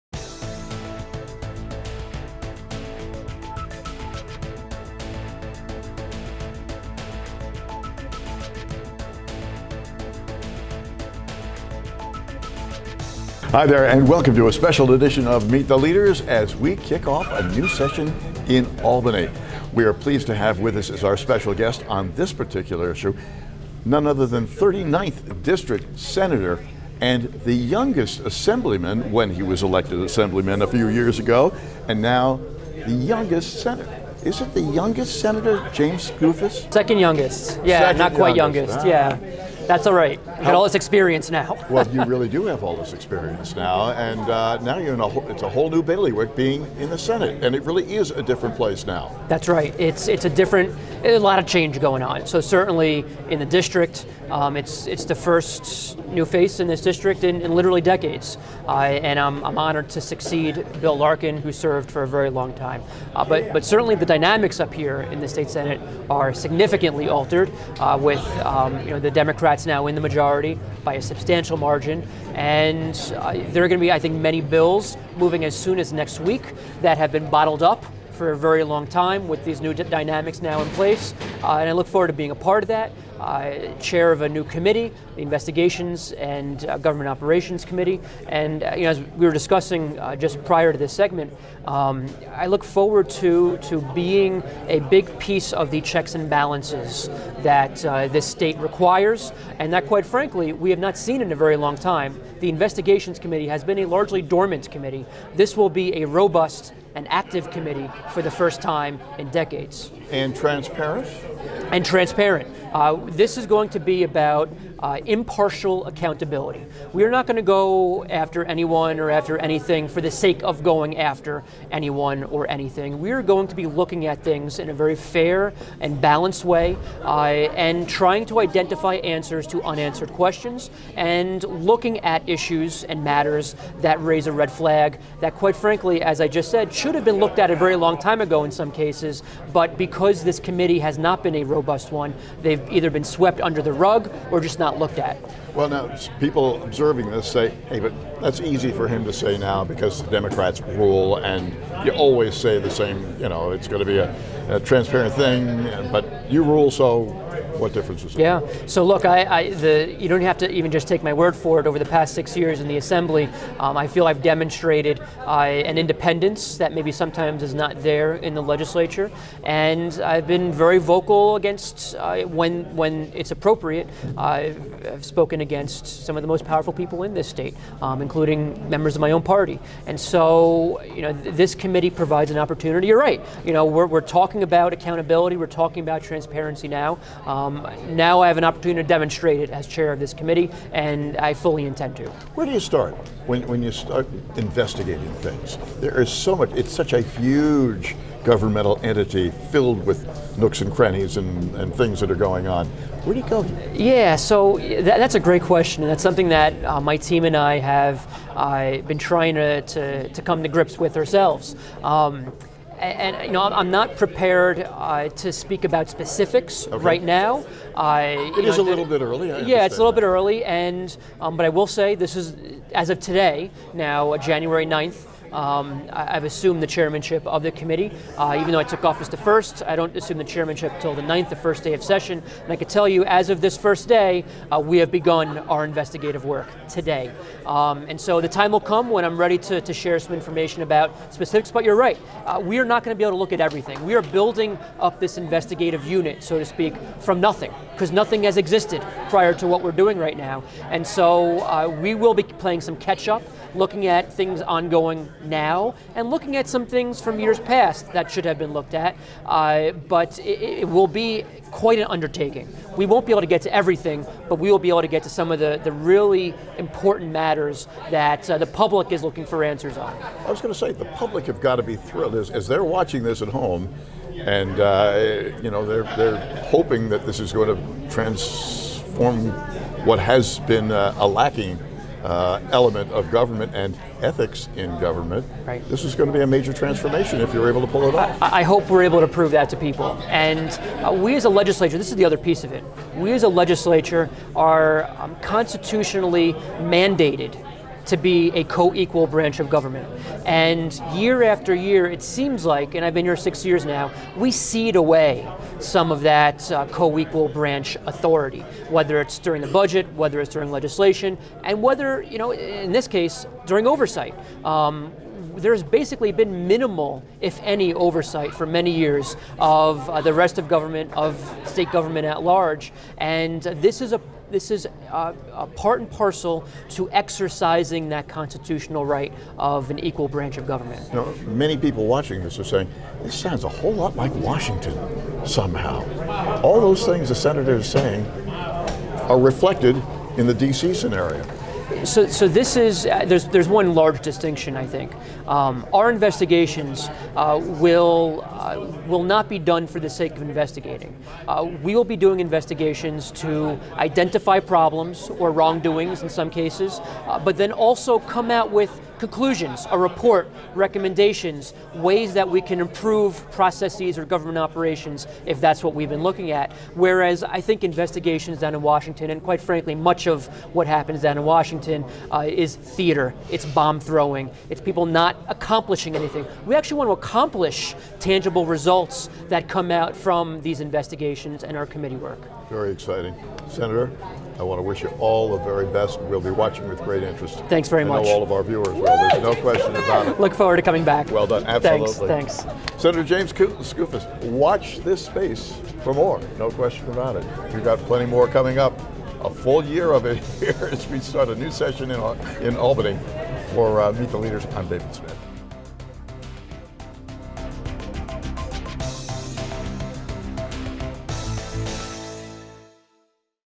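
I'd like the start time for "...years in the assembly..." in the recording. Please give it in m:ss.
2:42.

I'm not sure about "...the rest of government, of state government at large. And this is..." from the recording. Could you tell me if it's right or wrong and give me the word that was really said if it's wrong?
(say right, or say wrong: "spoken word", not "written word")
right.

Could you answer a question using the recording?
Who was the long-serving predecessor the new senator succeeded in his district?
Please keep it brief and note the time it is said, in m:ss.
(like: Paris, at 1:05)
Bill Larkin, at 1:00.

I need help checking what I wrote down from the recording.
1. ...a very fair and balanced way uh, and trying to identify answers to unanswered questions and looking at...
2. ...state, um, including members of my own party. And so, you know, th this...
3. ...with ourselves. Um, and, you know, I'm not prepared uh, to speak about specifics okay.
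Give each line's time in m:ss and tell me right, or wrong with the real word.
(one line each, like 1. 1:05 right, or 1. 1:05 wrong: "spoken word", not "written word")
1. 2:04 right
2. 2:57 right
3. 3:30 right.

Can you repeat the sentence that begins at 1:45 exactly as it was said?
This will be a robust and active committee for the first time in decades.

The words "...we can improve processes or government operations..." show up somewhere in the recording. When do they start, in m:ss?
6:02.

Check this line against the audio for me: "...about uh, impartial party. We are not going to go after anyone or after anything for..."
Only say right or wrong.
wrong.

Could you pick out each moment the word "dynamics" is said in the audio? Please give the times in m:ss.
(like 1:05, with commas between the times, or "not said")
1:04, 1:19.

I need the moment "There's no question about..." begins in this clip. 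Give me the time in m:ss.
6:29.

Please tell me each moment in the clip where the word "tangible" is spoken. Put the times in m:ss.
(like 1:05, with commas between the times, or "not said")
6:17.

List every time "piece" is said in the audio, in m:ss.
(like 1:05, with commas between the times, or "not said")
1:35, 4:52.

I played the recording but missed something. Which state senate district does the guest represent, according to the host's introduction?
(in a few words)
39th.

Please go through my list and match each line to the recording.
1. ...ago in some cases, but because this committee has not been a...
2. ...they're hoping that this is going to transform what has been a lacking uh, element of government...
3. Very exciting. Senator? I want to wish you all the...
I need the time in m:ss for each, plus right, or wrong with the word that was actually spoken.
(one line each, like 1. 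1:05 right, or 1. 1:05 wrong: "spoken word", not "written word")
1. 2:18 right
2. 4:35 right
3. 6:22 right.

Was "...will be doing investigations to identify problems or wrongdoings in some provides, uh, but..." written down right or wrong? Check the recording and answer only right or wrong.
wrong.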